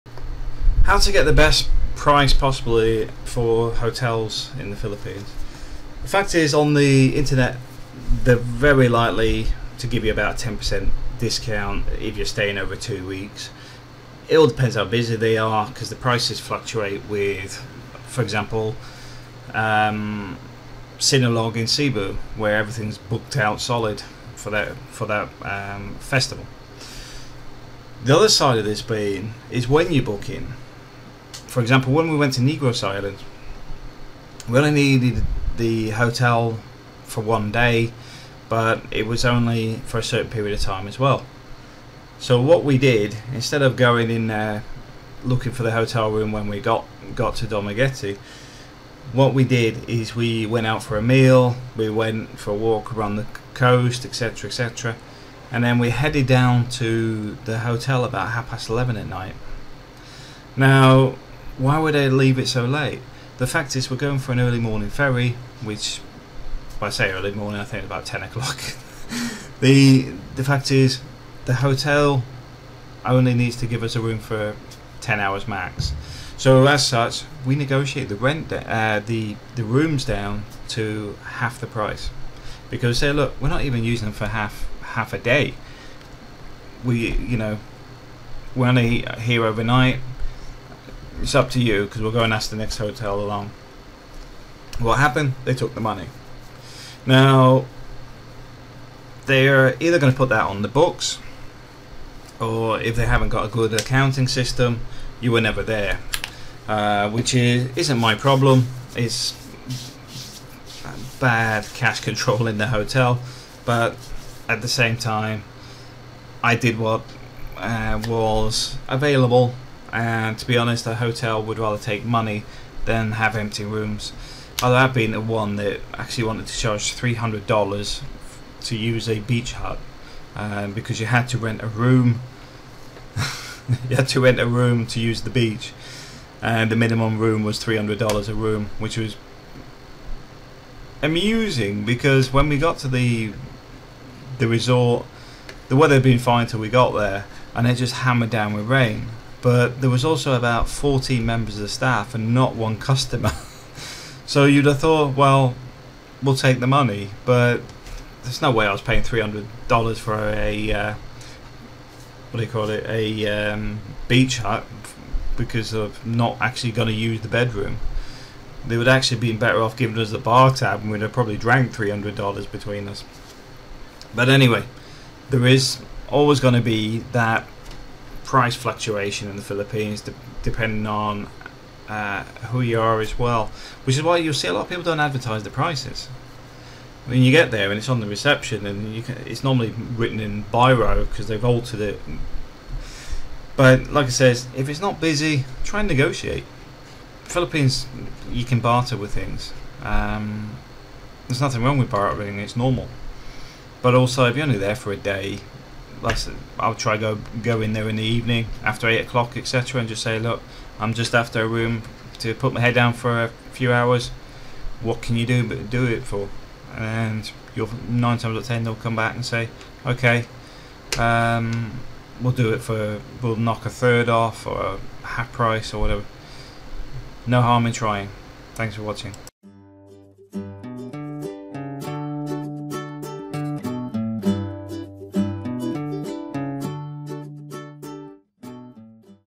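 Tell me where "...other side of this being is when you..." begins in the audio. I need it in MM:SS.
00:28.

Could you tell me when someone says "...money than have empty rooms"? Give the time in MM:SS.
02:02.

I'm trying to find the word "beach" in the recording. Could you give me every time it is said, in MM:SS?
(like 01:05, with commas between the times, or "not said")
02:09, 02:15, 02:44.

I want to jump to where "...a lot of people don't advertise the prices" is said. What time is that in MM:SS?
03:04.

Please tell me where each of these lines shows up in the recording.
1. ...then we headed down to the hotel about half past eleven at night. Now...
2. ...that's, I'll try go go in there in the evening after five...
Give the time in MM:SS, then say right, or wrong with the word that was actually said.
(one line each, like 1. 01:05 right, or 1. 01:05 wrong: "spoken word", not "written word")
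1. 00:55 right
2. 03:26 wrong: "eight", not "five".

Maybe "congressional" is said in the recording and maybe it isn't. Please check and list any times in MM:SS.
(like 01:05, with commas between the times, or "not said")
not said.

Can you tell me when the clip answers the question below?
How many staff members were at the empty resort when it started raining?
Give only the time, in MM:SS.
02:30.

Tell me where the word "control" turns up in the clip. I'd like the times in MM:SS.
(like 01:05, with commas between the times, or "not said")
01:51.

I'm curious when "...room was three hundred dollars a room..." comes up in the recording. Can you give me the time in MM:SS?
02:17.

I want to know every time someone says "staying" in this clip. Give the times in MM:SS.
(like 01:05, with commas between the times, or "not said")
00:12.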